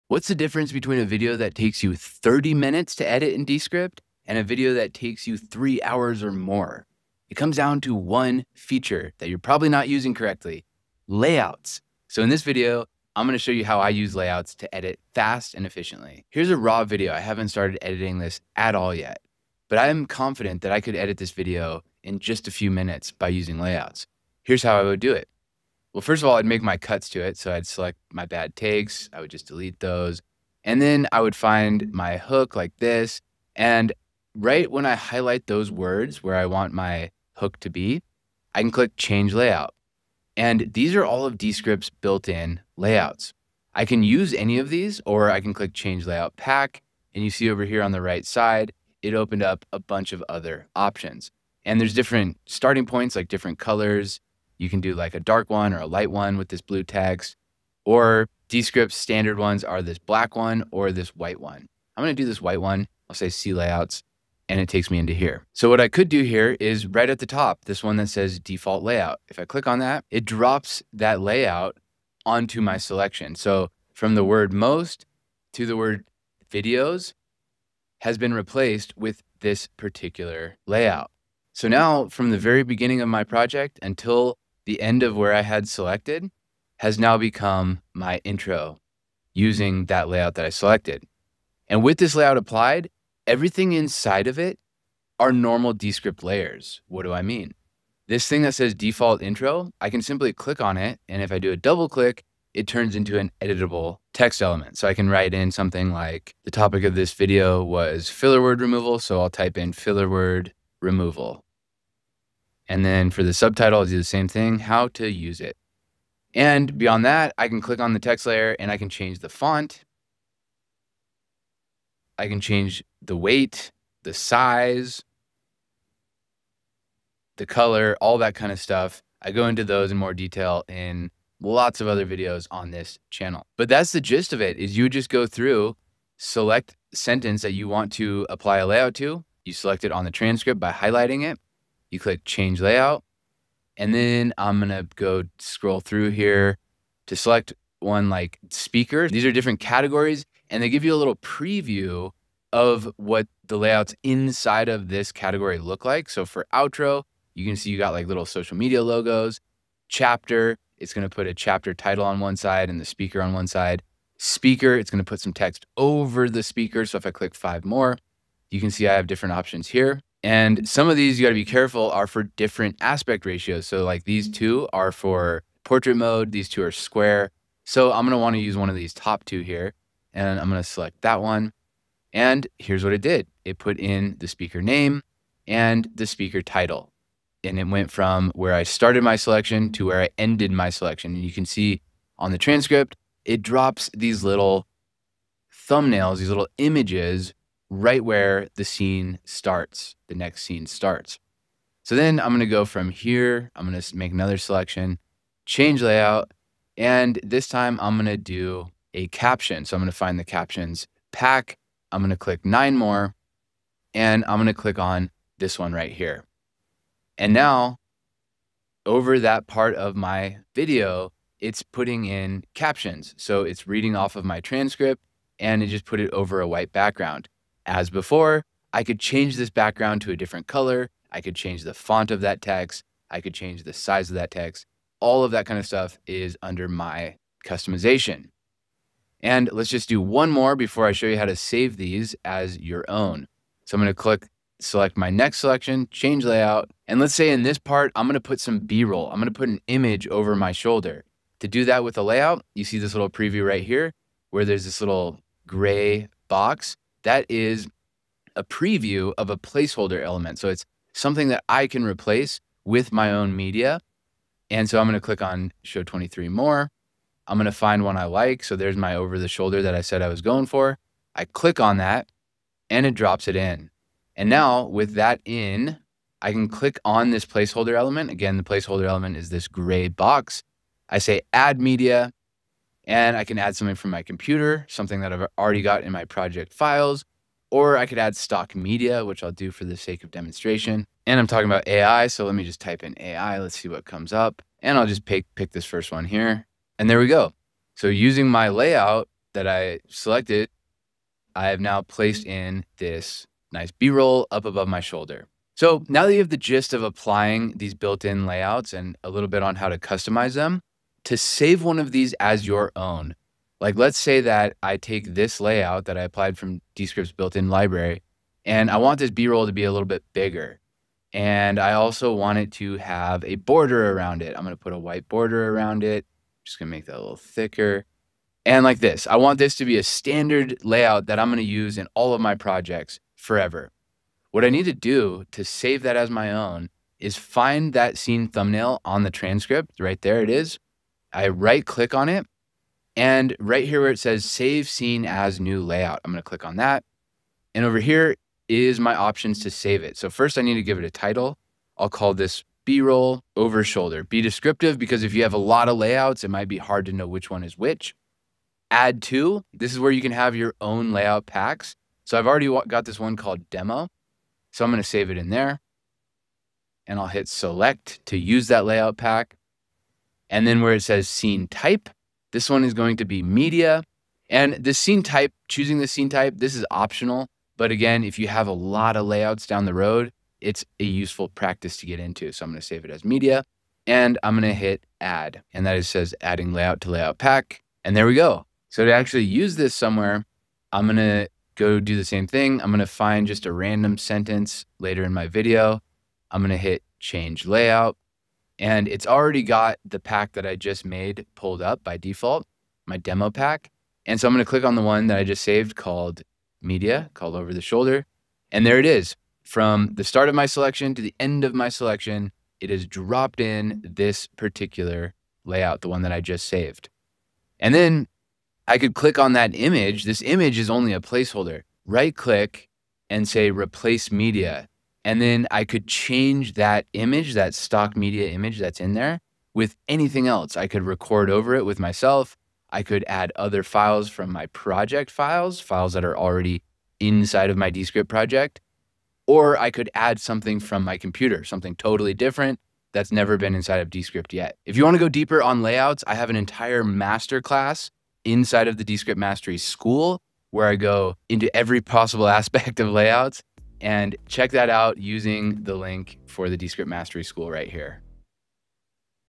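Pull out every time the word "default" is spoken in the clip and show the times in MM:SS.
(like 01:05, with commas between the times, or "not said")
01:08, 01:38, 06:41.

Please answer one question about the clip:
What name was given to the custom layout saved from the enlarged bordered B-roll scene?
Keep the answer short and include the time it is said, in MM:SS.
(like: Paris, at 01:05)
B-roll over shoulder, at 05:52.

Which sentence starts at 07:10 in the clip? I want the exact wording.
I could record over it with myself.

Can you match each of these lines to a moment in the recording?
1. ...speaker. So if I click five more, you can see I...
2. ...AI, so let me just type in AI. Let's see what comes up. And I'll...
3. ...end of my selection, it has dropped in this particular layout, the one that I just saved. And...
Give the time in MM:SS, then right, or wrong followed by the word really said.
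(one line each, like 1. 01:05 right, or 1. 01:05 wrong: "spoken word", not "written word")
1. 02:46 right
2. 04:51 right
3. 06:51 right.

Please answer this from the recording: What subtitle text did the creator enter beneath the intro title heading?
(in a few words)
How to use it.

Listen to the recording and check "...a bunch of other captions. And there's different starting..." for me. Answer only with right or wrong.
wrong.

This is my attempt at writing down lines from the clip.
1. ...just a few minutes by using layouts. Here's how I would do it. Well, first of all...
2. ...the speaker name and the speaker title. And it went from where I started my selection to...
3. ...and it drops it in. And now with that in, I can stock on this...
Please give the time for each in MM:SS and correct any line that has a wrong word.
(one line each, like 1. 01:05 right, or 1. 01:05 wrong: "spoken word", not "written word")
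1. 00:22 right
2. 03:04 right
3. 04:32 wrong: "click", not "stock".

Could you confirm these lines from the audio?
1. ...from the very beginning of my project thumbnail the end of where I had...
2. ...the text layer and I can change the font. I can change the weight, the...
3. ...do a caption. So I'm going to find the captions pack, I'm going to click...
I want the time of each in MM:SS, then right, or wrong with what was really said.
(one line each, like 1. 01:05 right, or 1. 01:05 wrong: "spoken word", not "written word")
1. 01:22 wrong: "until", not "thumbnail"
2. 01:57 right
3. 03:28 right.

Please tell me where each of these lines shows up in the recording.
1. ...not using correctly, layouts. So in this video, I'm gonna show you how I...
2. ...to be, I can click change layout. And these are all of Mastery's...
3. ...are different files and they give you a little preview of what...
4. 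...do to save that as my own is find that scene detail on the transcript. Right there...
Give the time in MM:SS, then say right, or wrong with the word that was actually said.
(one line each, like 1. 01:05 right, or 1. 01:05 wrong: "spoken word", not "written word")
1. 00:09 right
2. 00:37 wrong: "Descript", not "Mastery"
3. 02:29 wrong: "categories", not "files"
4. 05:34 wrong: "thumbnail", not "detail".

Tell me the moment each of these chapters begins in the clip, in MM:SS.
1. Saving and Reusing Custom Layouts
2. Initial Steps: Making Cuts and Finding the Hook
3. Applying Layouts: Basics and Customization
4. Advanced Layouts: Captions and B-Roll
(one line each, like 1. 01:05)
1. 05:05
2. 00:25
3. 01:03
4. 03:23.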